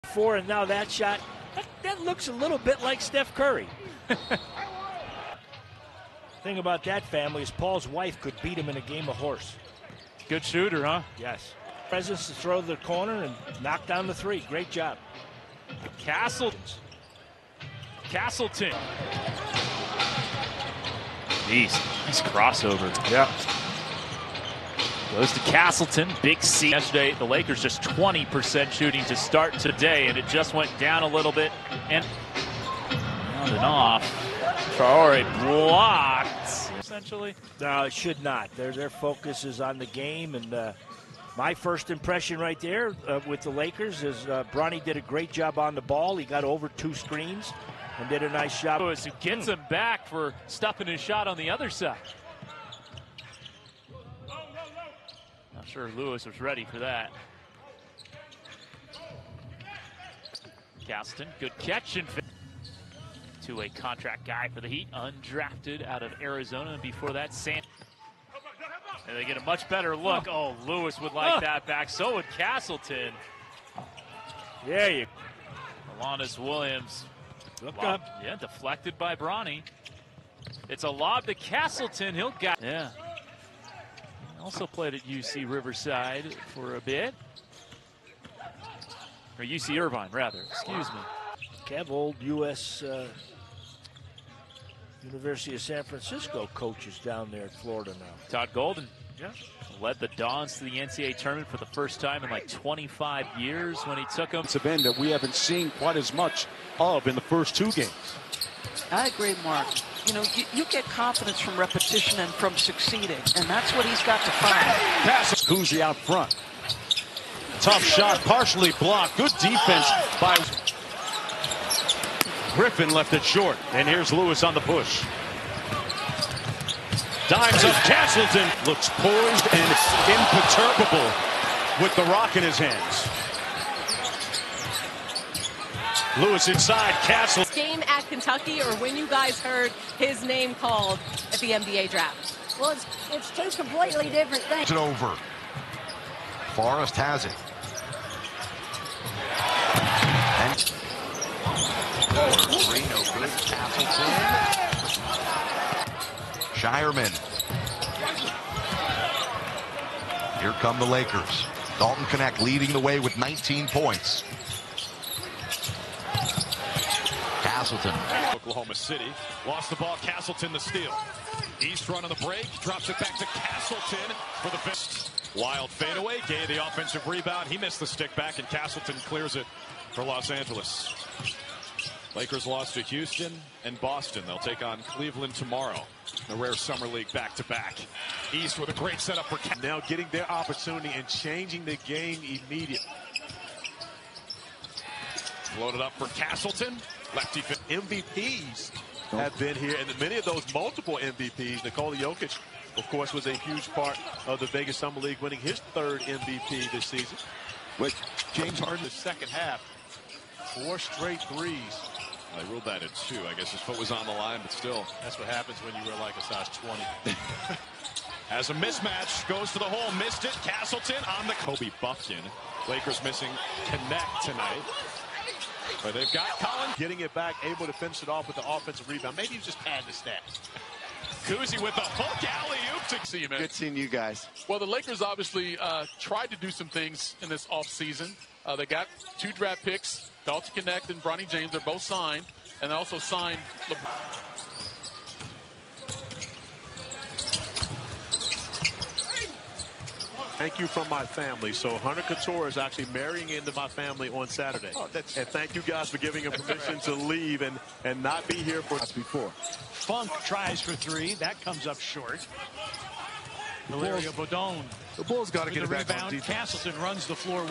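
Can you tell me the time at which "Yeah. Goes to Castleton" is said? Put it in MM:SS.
00:23.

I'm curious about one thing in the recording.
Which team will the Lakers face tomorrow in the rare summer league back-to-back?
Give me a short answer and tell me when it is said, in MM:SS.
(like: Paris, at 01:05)
Cleveland, at 03:04.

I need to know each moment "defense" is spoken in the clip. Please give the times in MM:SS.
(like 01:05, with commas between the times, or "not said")
01:59, 04:26.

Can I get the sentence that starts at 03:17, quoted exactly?
Lefty MVPs have been here, and many of those multiple MVPs.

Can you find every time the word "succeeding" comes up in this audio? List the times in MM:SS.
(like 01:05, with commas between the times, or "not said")
01:52.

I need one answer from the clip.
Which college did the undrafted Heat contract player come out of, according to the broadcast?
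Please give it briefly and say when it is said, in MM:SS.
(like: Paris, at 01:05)
Arizona, at 01:06.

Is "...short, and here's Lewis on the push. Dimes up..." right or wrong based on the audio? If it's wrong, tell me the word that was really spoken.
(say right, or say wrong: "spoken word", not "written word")
right.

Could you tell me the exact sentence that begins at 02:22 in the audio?
Well, it's, it's two completely different things.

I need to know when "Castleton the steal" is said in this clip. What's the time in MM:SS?
02:50.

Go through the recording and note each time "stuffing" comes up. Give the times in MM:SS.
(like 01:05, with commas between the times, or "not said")
00:50.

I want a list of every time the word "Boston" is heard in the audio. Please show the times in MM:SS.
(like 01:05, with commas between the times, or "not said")
03:03.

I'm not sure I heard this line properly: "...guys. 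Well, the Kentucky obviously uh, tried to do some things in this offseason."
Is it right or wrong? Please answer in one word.
wrong.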